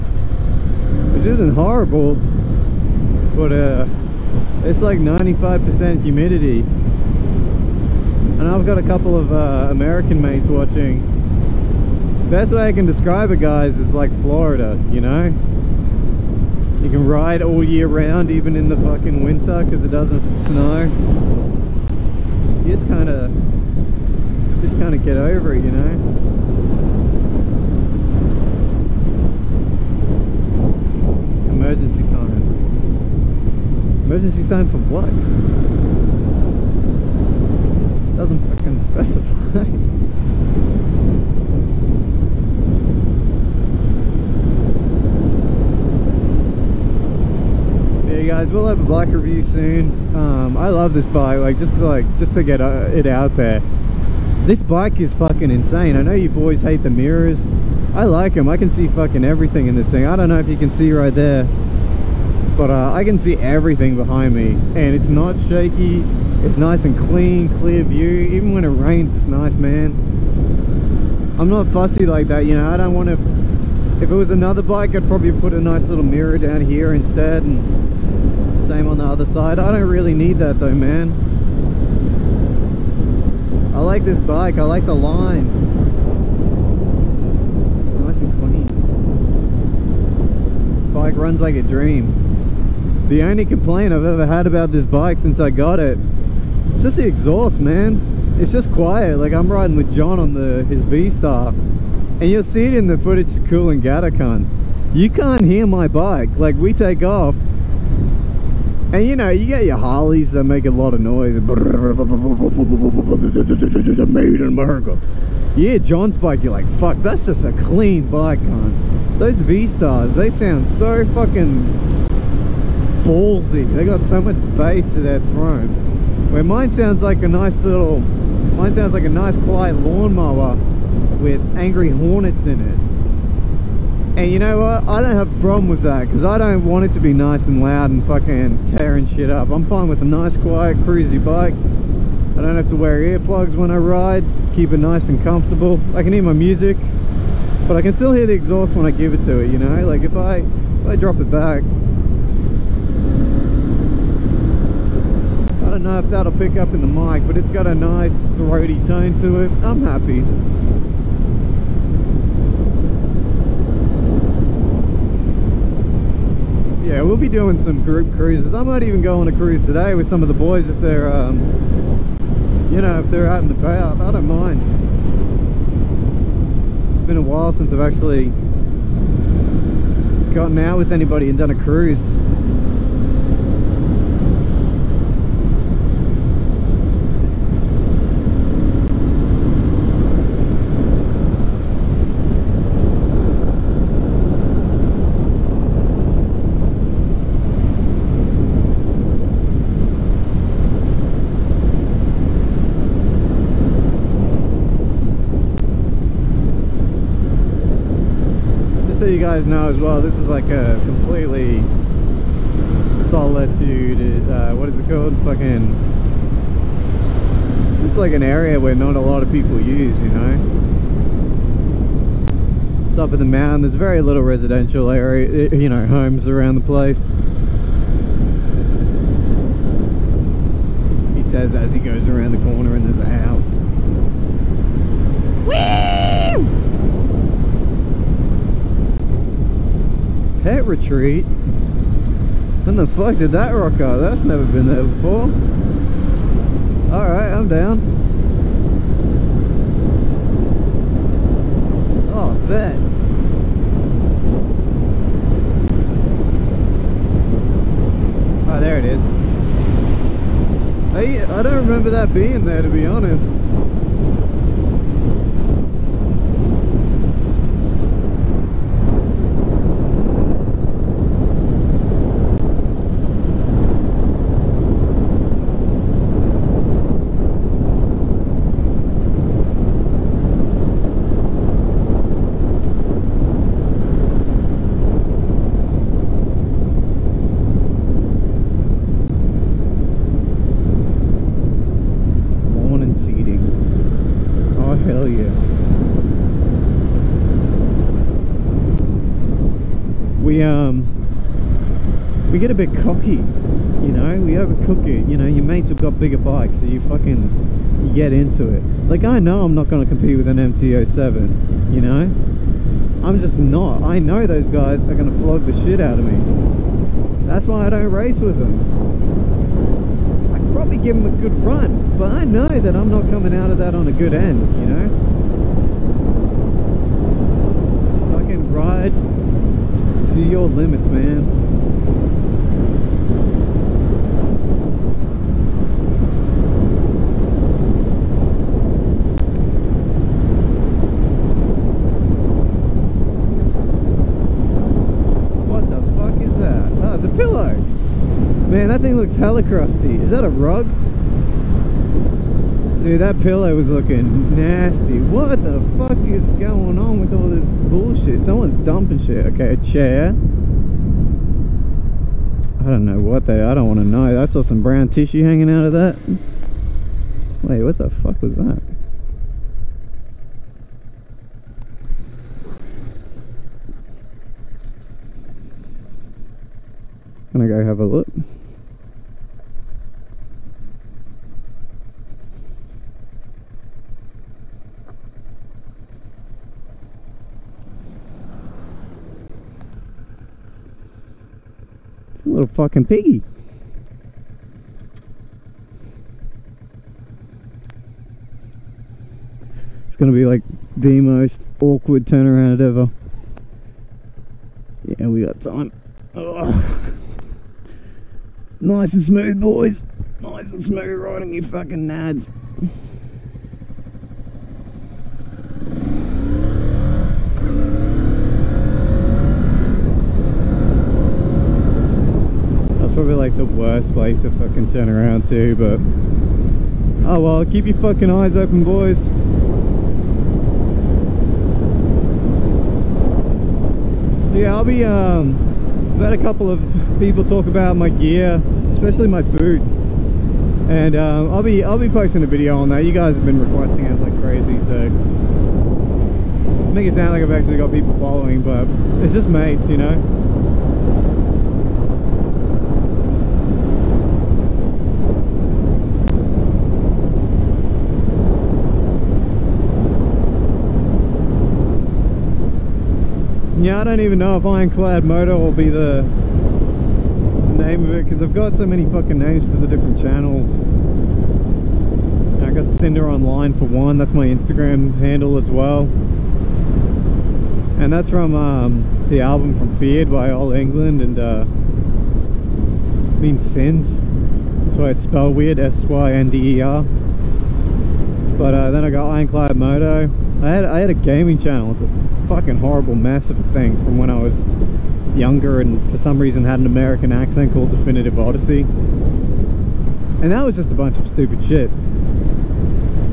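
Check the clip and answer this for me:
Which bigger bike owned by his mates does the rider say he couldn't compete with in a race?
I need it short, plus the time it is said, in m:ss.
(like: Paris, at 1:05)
MT-07, at 5:10.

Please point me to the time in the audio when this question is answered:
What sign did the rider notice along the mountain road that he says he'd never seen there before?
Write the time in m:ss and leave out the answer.
4:00.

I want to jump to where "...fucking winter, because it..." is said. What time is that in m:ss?
0:18.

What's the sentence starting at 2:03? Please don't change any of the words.
They got so much bass to their throne.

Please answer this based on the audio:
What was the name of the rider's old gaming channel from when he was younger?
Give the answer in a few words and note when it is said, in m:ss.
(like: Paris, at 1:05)
Definitive Odyssey, at 8:17.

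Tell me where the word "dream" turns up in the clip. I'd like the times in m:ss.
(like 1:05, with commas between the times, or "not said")
1:31.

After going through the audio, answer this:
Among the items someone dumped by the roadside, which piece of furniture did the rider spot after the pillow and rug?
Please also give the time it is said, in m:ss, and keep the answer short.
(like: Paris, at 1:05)
a chair, at 5:59.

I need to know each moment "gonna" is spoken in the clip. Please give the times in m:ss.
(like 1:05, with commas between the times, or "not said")
5:09, 5:14, 6:17, 6:39.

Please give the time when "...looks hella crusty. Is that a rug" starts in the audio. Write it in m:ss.
5:48.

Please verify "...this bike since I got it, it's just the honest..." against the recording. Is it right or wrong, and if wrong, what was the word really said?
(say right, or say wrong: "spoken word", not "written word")
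wrong: "exhaust", not "honest".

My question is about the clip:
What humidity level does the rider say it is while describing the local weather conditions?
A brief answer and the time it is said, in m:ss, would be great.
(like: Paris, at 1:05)
95%, at 0:04.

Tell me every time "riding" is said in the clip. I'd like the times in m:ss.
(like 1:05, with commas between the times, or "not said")
1:39, 6:50.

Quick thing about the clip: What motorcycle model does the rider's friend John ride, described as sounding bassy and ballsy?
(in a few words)
V-Star.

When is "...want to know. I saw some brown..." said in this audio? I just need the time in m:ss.
6:03.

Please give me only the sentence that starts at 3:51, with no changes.
He says as he goes around the corner and there's a house.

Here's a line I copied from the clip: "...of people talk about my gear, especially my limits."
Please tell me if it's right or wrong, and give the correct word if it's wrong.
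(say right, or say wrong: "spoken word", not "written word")
wrong: "boots", not "limits".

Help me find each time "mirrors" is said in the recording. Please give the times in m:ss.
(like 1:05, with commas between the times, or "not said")
0:56, 1:16.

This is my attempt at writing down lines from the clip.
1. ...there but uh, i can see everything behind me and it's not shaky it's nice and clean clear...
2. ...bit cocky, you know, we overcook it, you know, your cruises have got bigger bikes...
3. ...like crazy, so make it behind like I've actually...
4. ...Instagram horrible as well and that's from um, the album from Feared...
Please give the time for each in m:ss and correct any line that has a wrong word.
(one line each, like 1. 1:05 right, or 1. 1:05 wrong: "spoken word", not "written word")
1. 1:01 right
2. 5:02 wrong: "mates", not "cruises"
3. 7:23 wrong: "sound", not "behind"
4. 7:54 wrong: "handle", not "horrible".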